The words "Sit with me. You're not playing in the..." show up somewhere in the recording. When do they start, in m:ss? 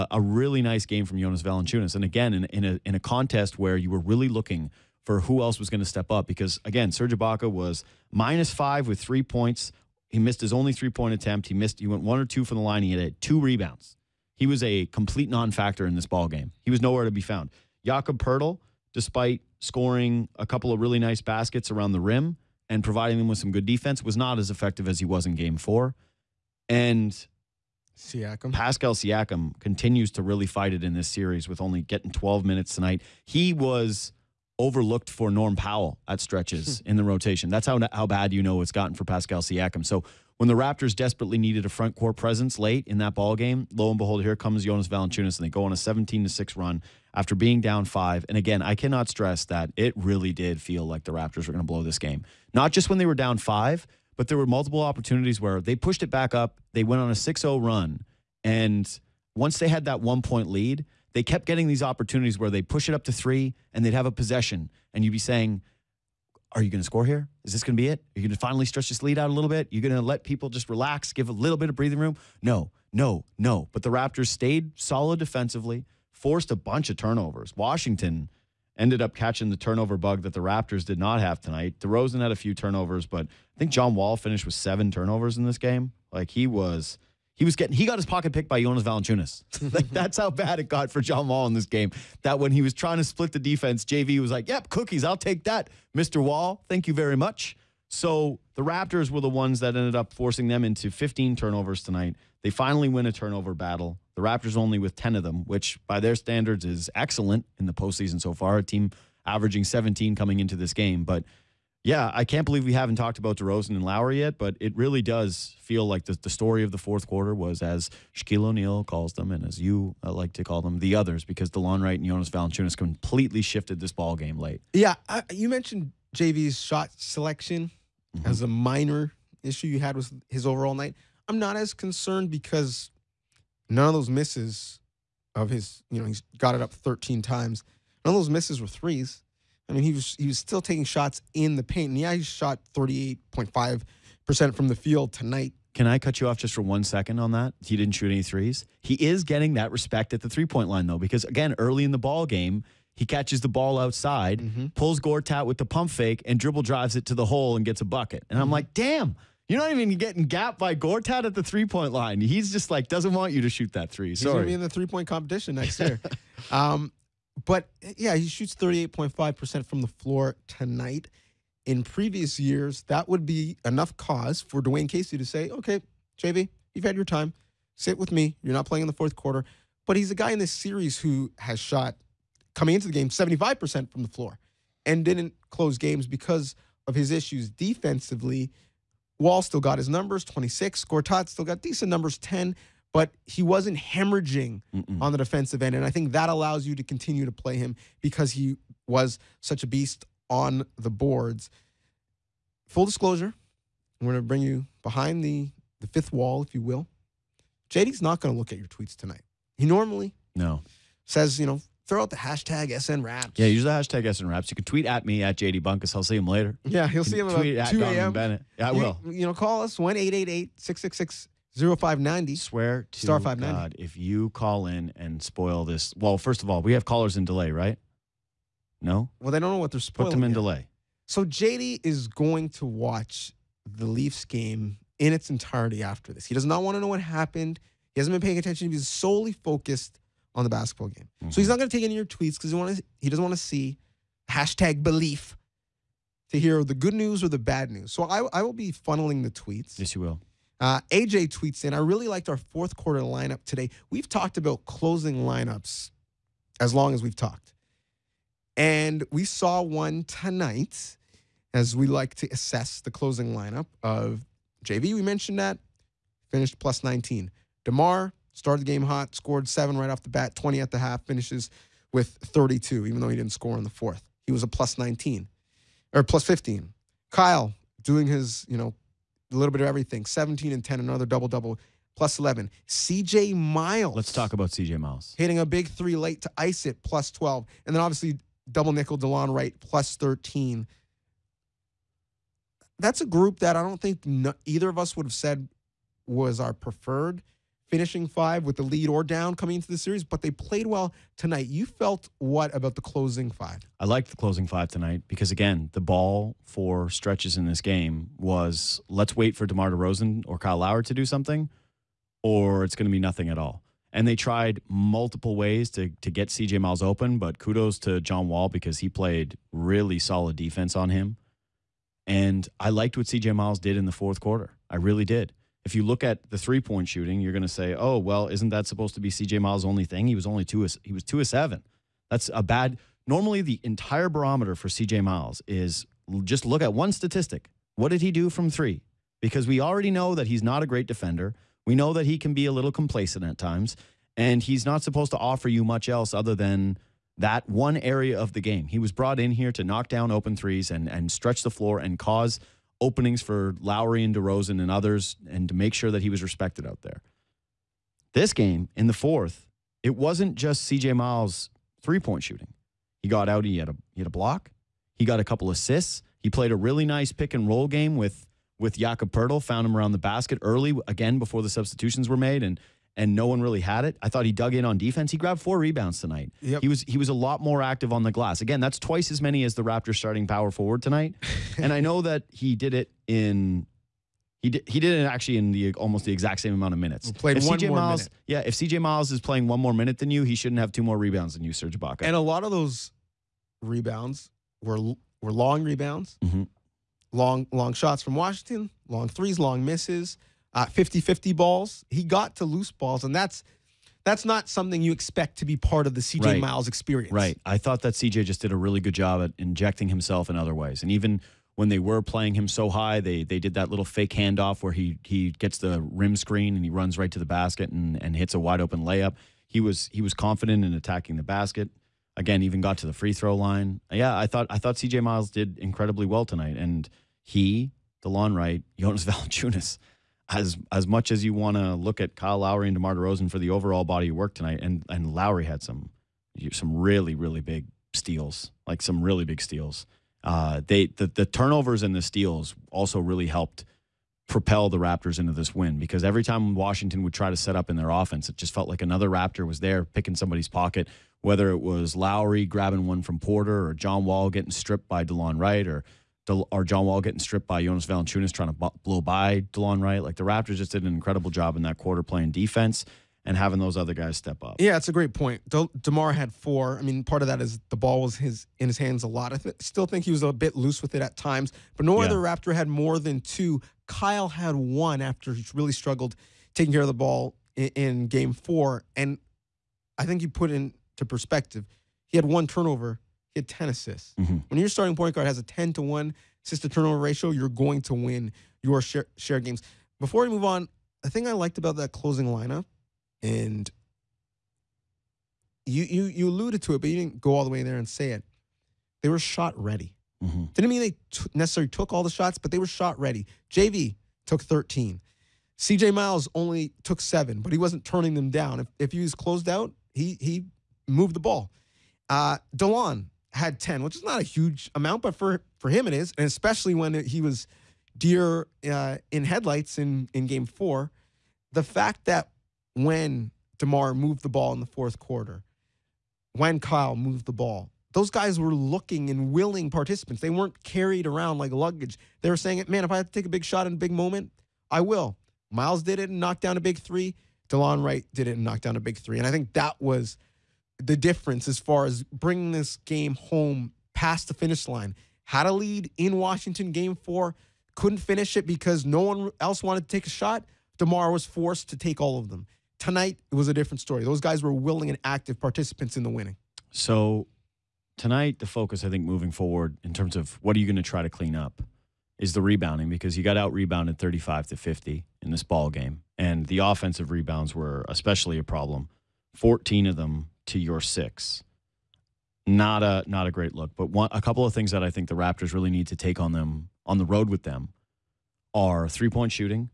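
2:57.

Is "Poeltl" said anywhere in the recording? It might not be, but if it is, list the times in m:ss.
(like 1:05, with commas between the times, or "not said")
0:18, 6:09.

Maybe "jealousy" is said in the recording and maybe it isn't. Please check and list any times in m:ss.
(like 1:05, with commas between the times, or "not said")
not said.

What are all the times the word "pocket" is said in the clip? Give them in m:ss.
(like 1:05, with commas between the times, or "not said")
1:28, 7:30.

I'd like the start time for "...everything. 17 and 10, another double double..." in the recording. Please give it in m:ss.
4:39.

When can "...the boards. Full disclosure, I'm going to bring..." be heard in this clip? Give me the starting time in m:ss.
3:20.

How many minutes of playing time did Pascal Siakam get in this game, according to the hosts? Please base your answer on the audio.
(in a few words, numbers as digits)
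12.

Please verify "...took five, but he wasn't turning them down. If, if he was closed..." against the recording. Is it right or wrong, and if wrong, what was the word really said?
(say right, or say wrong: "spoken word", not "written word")
wrong: "seven", not "five".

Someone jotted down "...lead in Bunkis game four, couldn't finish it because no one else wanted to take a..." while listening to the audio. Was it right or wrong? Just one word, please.
wrong.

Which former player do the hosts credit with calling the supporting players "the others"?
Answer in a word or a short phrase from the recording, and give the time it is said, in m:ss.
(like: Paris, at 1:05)
Shaquille O'Neal, at 1:58.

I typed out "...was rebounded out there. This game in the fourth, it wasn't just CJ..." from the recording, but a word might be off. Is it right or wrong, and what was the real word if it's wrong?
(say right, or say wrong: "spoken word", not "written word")
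wrong: "respected", not "rebounded".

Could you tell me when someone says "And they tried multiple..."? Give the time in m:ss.
5:13.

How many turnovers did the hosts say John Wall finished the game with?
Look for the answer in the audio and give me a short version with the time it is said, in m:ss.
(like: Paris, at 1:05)
7, at 1:24.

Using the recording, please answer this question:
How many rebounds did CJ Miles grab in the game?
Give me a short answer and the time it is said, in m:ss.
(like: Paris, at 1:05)
4, at 6:15.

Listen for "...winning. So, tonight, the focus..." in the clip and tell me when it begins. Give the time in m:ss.
9:16.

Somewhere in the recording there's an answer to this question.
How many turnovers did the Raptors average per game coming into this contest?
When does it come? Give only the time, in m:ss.
1:49.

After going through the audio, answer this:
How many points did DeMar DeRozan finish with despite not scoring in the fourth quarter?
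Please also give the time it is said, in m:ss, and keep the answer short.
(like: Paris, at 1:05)
32, at 4:32.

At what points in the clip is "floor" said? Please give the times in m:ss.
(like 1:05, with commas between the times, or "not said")
2:49, 3:04, 5:51.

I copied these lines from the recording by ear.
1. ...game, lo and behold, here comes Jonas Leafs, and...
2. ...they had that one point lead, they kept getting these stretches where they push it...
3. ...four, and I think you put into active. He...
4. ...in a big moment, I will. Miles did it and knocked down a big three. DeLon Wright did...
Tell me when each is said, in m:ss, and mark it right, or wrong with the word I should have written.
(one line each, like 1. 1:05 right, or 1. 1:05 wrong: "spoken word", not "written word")
1. 0:43 wrong: "Valanciunas", not "Leafs"
2. 0:59 wrong: "opportunities", not "stretches"
3. 7:58 wrong: "perspective", not "active"
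4. 8:53 right.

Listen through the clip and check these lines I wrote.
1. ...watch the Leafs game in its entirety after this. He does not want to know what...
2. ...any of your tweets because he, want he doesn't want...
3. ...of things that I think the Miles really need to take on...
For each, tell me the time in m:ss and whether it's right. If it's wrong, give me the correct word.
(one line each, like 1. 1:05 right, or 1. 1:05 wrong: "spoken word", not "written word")
1. 3:52 right
2. 4:01 right
3. 9:34 wrong: "Raptors", not "Miles".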